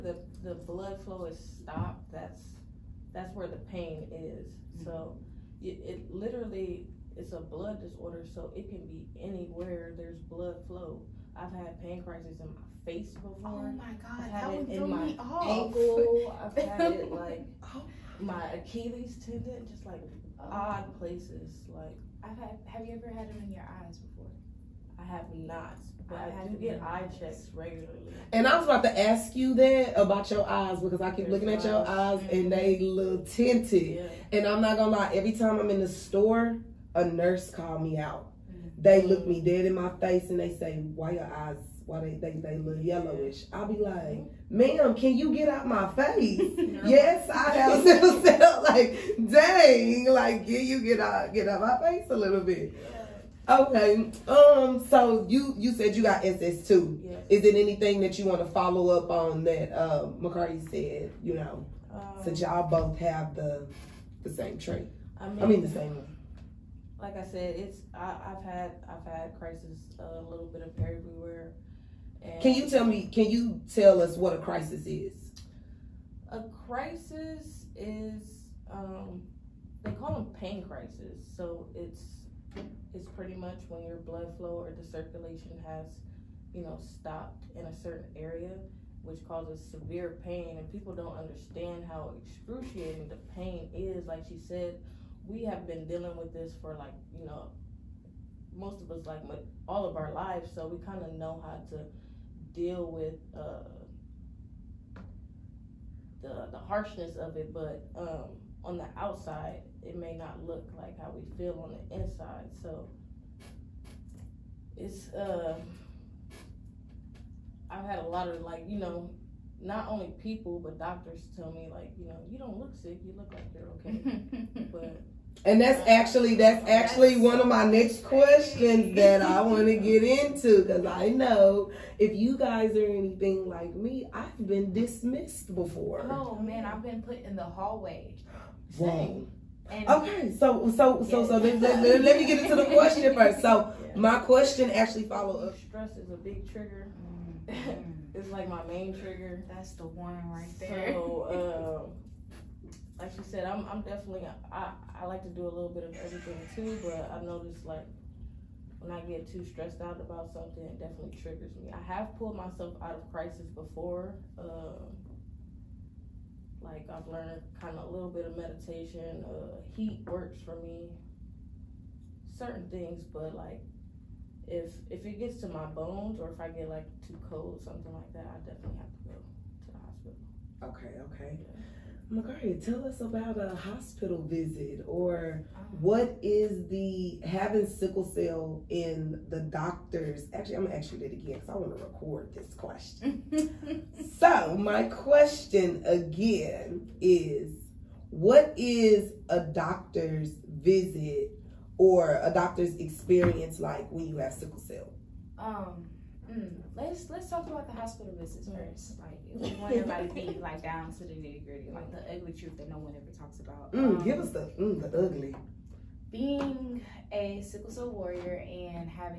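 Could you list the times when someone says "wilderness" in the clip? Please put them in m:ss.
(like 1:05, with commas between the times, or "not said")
not said.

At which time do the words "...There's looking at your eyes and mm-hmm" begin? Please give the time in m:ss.
0:31.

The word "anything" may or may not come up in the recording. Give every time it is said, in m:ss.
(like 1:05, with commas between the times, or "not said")
0:57, 2:12.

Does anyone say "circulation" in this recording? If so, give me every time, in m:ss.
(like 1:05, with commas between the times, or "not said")
1:24.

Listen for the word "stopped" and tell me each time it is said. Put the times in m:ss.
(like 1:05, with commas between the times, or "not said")
0:01, 1:26.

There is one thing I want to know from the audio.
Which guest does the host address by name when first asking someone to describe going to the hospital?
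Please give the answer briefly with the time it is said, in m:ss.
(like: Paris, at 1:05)
Margaria, at 3:02.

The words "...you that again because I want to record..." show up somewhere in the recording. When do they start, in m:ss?
3:10.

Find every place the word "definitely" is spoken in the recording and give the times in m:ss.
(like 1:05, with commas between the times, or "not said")
2:33, 2:40, 2:58.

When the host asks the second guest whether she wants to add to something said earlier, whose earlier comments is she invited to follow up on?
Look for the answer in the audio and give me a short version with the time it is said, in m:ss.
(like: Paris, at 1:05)
McCarty, at 1:00.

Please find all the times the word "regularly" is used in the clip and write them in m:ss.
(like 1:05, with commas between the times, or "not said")
0:27.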